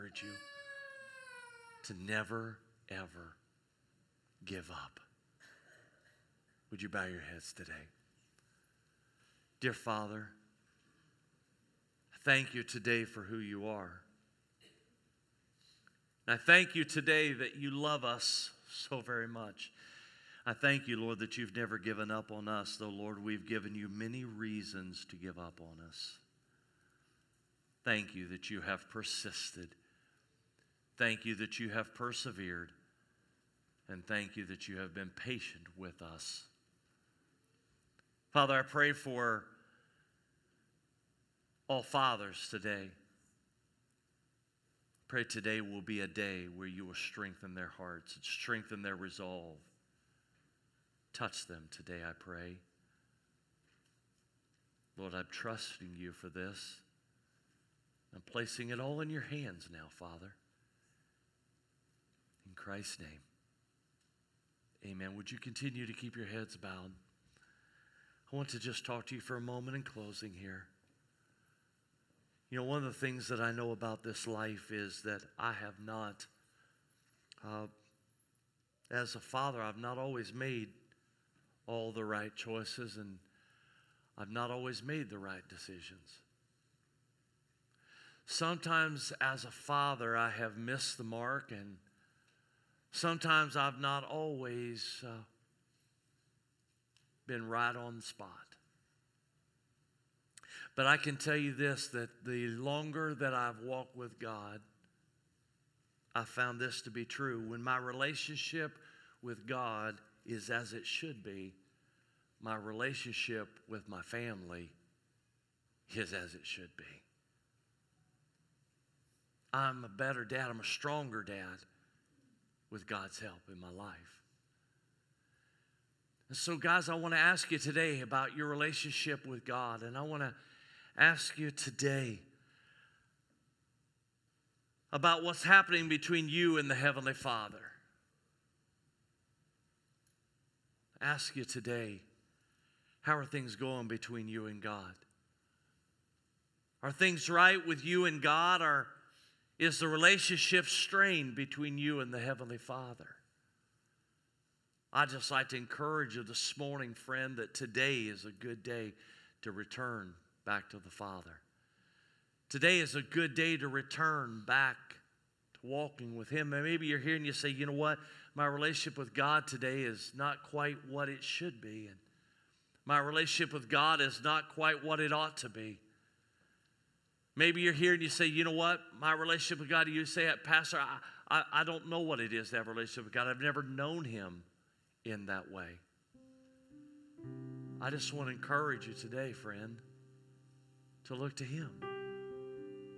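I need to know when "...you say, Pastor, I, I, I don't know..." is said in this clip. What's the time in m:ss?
2:59.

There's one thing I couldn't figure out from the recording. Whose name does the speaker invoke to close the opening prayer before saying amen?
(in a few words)
Christ.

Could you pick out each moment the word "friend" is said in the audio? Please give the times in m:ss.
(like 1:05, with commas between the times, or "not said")
2:36, 3:09.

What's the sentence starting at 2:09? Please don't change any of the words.
And I want to ask you today about what's happening between you and the Heavenly Father.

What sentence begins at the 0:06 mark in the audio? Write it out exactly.
Would you bow your heads today?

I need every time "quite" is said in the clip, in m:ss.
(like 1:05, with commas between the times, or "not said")
2:50, 2:54.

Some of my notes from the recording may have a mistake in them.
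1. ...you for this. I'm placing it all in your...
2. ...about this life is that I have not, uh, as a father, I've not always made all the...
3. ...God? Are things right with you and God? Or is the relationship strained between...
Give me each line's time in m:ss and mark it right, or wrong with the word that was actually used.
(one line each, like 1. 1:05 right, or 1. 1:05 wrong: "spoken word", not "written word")
1. 0:55 right
2. 1:13 right
3. 2:24 right.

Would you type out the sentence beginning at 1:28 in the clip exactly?
Sometimes, as a father, I have missed the mark, and sometimes I've not always uh, been right on the spot.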